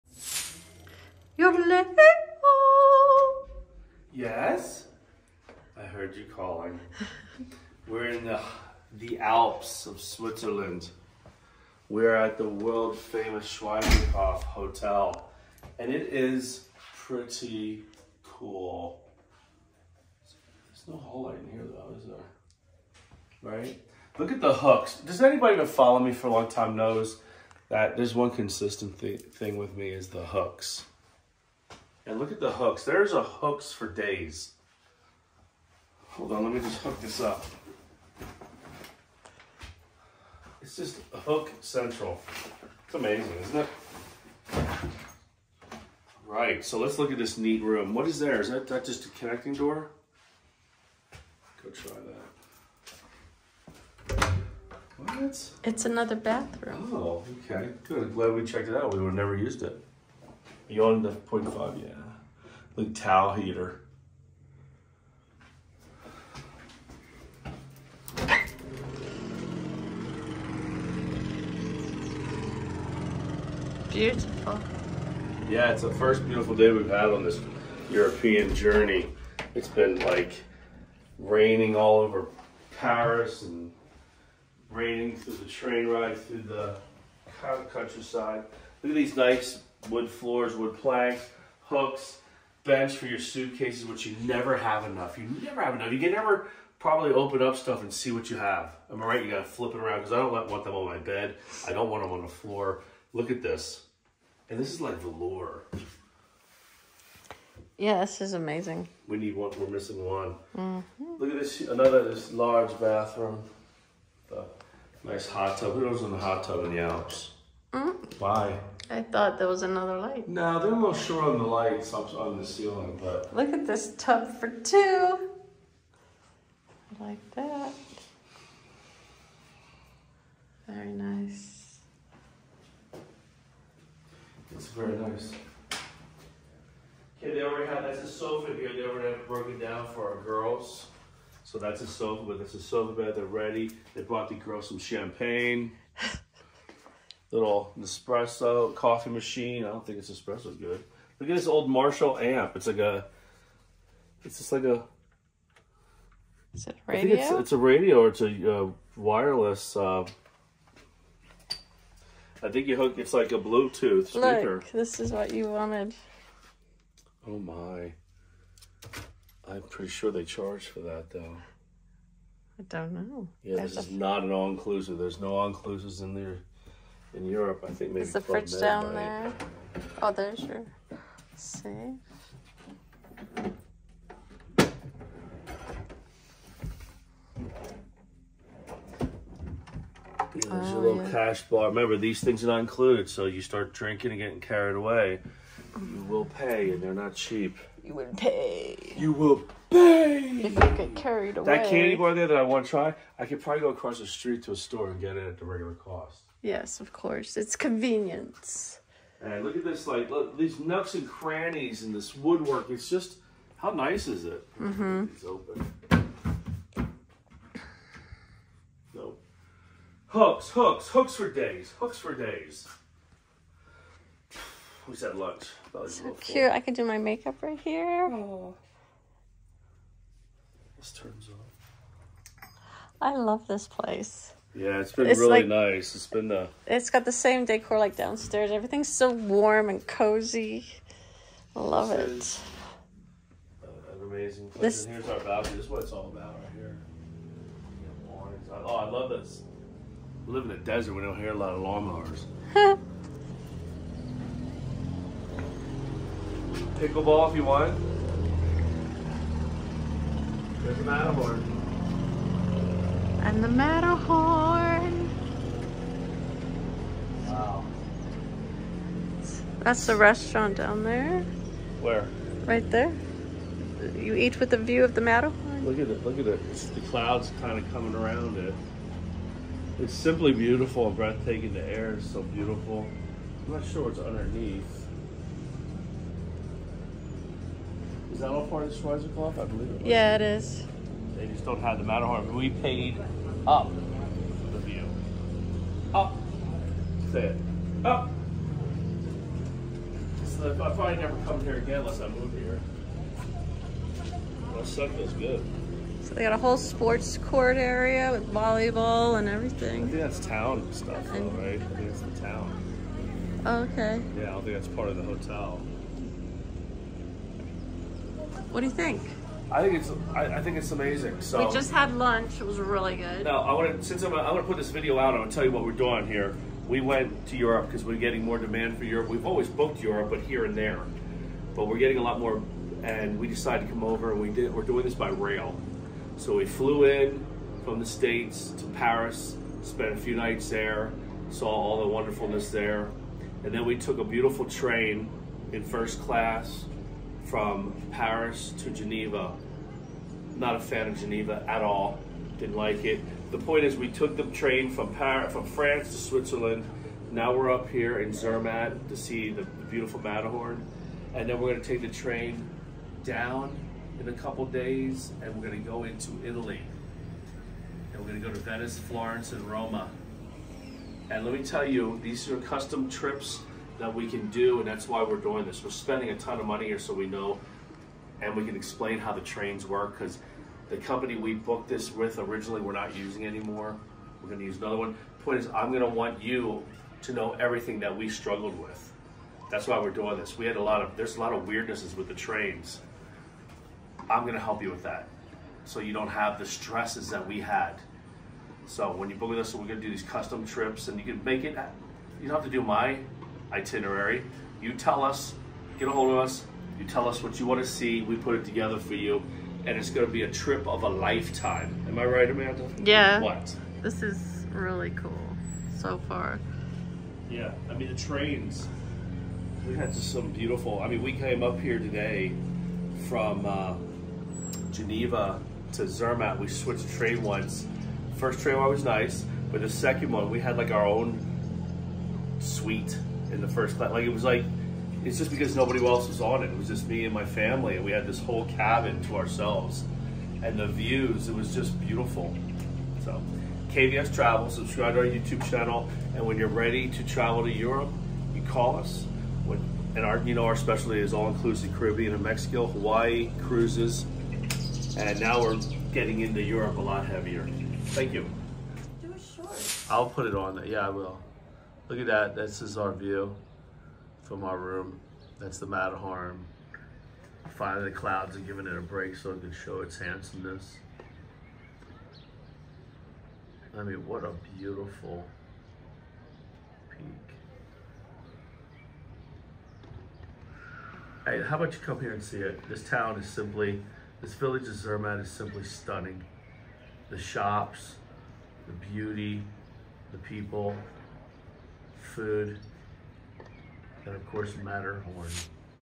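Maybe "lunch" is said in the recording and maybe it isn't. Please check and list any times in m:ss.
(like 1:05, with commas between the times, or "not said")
3:45, 5:21.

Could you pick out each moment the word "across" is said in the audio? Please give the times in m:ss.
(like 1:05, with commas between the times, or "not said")
3:23.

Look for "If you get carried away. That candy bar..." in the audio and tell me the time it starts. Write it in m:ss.
3:20.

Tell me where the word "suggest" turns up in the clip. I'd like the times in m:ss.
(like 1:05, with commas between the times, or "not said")
not said.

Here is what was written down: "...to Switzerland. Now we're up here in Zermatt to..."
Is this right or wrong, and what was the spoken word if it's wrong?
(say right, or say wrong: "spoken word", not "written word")
right.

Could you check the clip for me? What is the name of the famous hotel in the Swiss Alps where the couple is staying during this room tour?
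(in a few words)
Schweizerhof Hotel.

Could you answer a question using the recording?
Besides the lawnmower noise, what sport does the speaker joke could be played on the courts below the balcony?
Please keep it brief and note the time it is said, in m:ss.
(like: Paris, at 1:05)
Pickleball, at 4:16.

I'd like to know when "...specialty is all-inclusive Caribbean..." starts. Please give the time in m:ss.
7:30.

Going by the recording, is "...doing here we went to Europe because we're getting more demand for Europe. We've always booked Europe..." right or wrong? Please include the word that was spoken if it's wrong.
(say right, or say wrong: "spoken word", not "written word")
right.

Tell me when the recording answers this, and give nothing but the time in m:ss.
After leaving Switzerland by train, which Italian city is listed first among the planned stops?
6:08.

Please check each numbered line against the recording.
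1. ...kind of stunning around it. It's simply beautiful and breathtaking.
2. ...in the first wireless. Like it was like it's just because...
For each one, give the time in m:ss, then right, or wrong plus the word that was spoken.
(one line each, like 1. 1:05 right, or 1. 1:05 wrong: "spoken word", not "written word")
1. 4:37 wrong: "coming", not "stunning"
2. 7:13 wrong: "class", not "wireless".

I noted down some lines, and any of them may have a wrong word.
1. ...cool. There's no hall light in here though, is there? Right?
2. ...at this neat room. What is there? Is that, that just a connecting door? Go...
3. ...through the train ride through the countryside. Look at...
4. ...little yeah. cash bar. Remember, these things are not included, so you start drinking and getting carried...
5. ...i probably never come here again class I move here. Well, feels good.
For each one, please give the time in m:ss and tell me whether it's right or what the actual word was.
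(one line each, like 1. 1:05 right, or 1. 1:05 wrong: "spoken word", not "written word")
1. 0:18 right
2. 0:47 right
3. 1:25 right
4. 3:10 right
5. 5:00 wrong: "unless", not "class".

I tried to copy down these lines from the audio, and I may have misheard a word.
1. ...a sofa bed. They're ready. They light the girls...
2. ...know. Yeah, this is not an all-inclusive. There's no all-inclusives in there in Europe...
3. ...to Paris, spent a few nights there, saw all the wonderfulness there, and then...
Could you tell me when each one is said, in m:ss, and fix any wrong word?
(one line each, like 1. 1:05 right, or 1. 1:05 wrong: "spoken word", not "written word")
1. 2:22 wrong: "brought", not "light"
2. 2:52 right
3. 5:38 right.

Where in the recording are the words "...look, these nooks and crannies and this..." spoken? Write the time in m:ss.
3:30.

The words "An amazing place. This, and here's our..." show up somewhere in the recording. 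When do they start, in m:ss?
4:03.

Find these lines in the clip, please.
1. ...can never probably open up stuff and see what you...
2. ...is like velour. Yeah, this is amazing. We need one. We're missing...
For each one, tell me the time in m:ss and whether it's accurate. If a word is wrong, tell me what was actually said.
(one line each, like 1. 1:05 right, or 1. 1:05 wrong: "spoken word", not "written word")
1. 1:35 right
2. 1:44 right.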